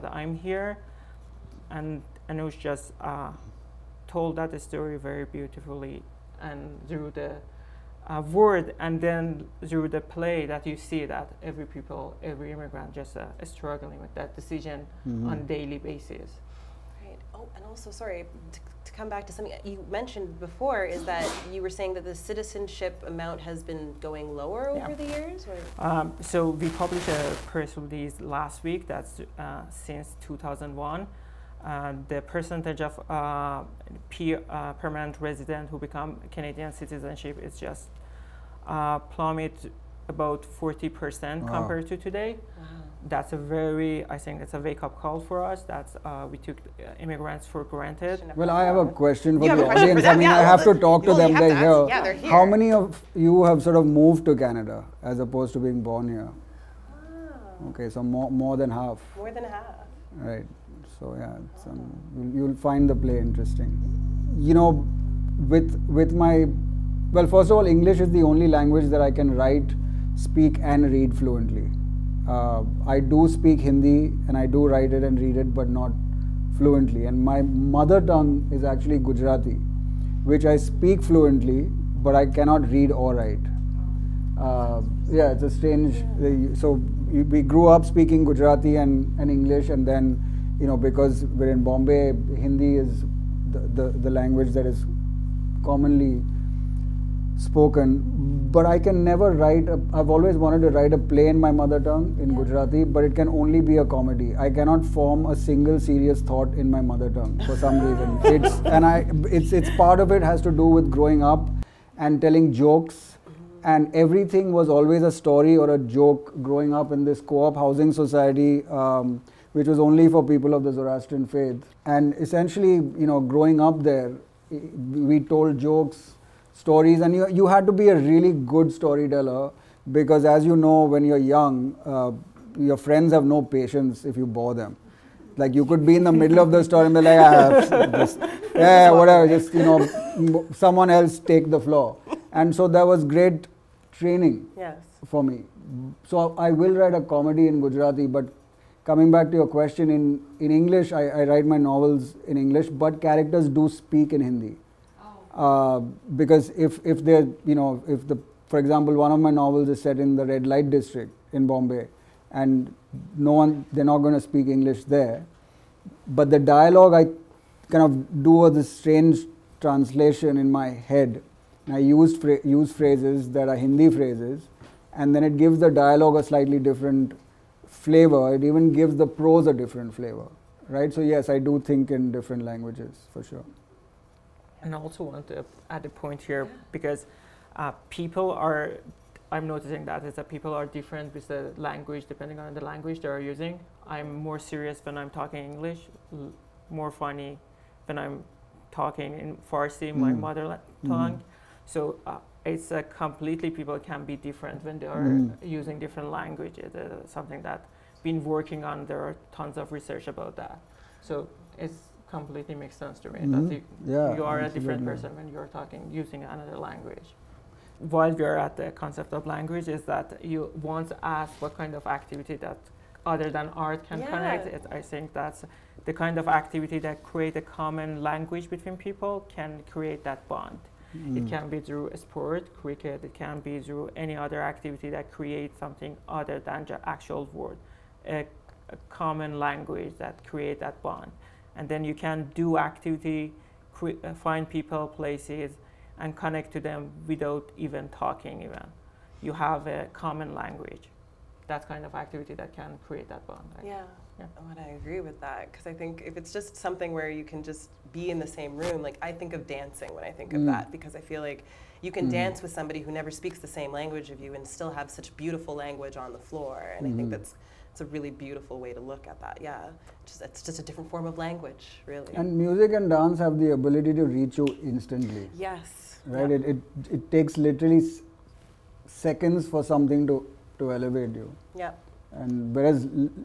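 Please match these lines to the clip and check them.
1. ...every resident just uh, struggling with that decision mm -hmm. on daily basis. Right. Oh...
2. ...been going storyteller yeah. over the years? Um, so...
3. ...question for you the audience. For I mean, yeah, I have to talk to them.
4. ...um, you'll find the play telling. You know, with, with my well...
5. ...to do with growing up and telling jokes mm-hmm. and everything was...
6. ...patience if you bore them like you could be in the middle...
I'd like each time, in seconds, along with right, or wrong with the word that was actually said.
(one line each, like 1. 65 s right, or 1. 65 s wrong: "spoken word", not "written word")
1. 12 s wrong: "immigrant", not "resident"
2. 23 s wrong: "lower", not "storyteller"
3. 48 s right
4. 61 s wrong: "interesting", not "telling"
5. 110 s right
6. 133 s right.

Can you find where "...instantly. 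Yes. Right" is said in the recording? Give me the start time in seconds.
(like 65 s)
274 s.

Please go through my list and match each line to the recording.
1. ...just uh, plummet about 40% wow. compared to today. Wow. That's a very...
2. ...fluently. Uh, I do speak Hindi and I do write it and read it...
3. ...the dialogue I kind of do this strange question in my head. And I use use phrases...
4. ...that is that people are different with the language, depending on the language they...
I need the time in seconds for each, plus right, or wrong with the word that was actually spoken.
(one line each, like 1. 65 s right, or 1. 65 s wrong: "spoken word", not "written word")
1. 37 s right
2. 71 s right
3. 166 s wrong: "translation", not "question"
4. 189 s right.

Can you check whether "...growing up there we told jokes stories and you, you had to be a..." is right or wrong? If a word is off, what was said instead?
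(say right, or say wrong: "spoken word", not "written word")
right.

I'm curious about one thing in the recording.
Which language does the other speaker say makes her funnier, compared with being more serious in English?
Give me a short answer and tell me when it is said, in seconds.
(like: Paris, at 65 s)
Farsi, at 199 s.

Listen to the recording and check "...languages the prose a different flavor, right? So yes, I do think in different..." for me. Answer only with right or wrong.
wrong.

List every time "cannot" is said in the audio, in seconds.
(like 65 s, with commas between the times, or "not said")
82 s, 104 s.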